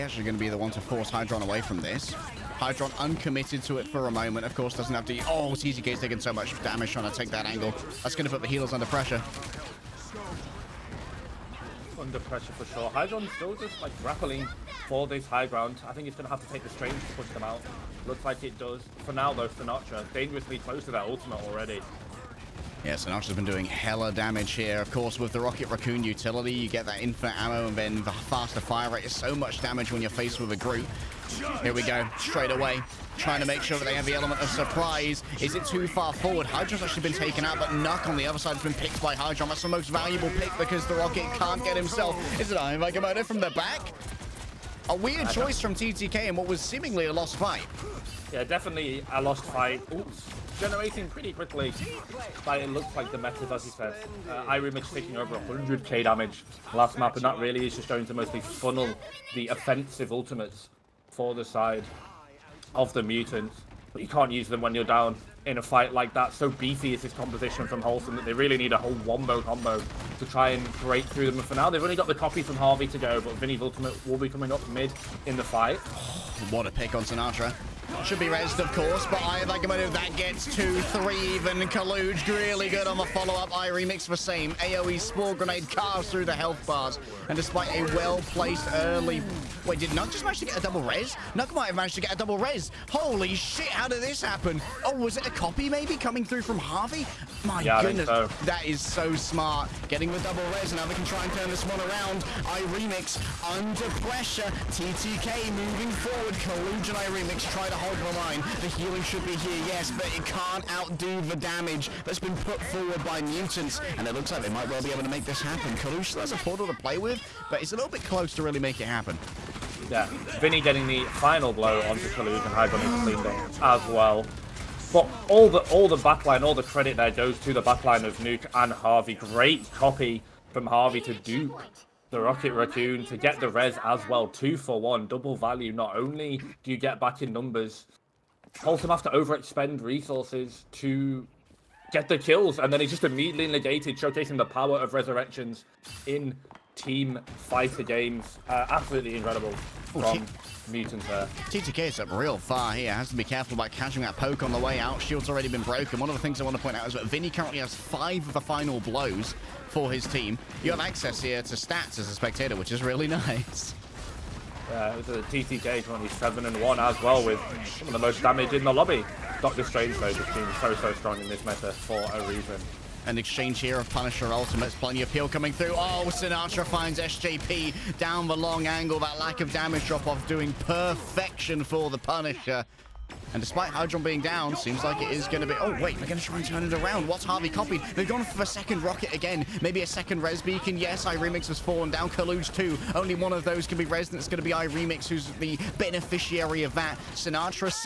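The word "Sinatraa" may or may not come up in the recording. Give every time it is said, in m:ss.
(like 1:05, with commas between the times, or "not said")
0:19, 1:17, 2:56, 3:17.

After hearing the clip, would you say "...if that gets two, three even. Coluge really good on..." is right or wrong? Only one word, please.
right.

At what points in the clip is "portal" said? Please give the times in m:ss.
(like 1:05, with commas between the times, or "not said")
1:56.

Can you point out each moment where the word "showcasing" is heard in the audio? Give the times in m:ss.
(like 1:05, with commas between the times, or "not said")
2:23.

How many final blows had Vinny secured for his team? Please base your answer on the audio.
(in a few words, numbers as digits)
5.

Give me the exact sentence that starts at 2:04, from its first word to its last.
But all the all the backline, all the credit there goes to the backline of Nuke and Harvey.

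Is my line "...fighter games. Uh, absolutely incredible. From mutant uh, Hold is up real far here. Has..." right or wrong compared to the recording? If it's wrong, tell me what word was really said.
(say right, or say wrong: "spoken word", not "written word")
wrong: "TTK", not "Hold".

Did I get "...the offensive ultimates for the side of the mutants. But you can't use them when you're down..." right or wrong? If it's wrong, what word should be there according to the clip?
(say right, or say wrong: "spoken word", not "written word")
right.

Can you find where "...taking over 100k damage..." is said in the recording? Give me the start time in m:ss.
0:54.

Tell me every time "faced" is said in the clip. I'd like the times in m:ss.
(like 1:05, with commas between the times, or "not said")
0:30.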